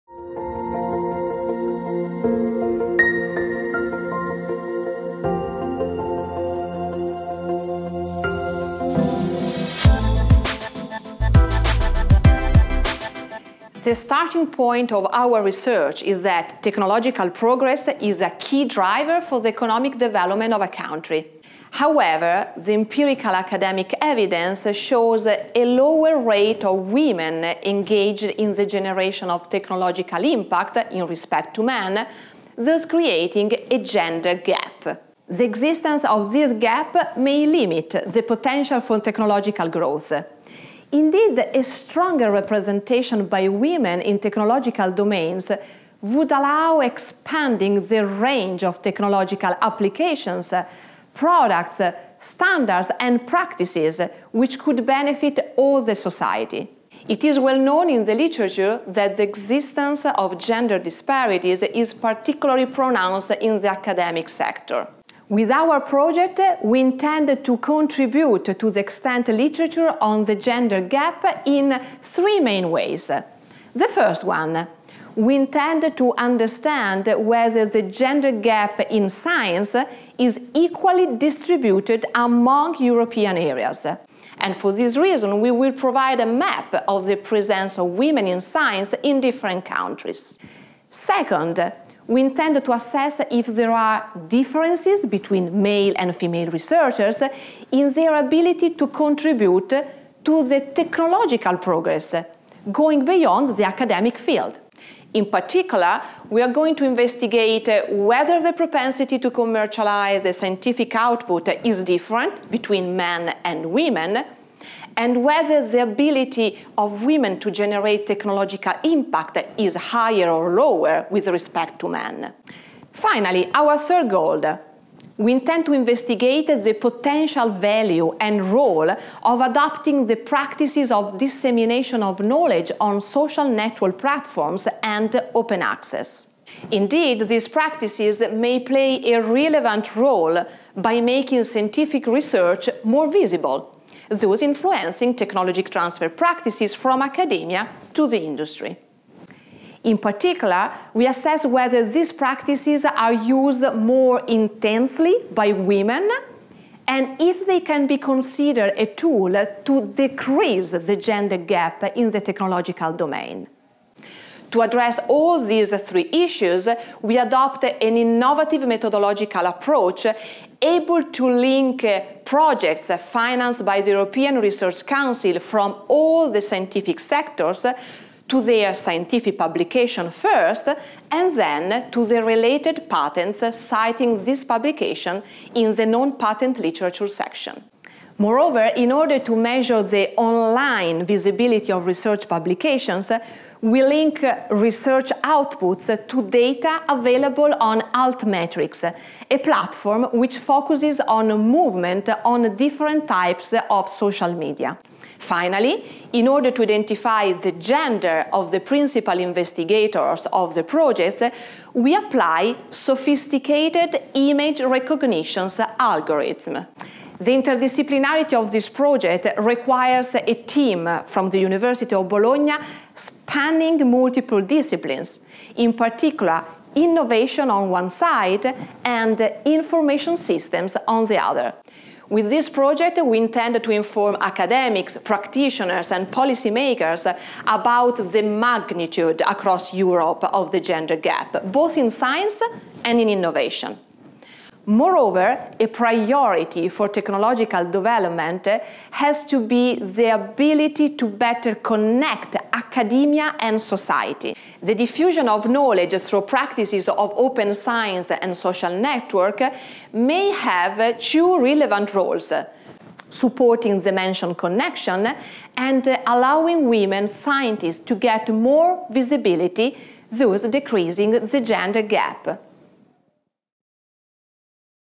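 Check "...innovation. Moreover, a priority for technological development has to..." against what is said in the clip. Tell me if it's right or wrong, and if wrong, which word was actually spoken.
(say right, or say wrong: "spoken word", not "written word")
right.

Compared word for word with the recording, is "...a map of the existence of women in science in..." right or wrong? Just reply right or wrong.
wrong.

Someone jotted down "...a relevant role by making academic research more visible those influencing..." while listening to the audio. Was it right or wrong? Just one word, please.
wrong.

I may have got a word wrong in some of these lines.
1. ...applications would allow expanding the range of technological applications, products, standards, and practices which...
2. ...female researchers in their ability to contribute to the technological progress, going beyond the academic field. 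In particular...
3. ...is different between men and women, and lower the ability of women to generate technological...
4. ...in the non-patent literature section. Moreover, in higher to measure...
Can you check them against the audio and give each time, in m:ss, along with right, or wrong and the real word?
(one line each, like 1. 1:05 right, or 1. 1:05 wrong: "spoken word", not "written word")
1. 0:44 wrong: "domains", not "applications"
2. 1:36 right
3. 1:51 wrong: "whether", not "lower"
4. 3:05 wrong: "order", not "higher".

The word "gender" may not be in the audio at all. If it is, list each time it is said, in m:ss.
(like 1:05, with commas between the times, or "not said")
0:33, 1:00, 1:10, 1:17, 2:40, 3:27, 4:00, 4:31.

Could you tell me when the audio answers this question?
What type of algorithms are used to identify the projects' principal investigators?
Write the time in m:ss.
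3:34.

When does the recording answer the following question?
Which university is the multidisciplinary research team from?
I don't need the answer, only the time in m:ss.
3:41.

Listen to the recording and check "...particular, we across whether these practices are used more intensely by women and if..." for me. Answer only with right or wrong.
wrong.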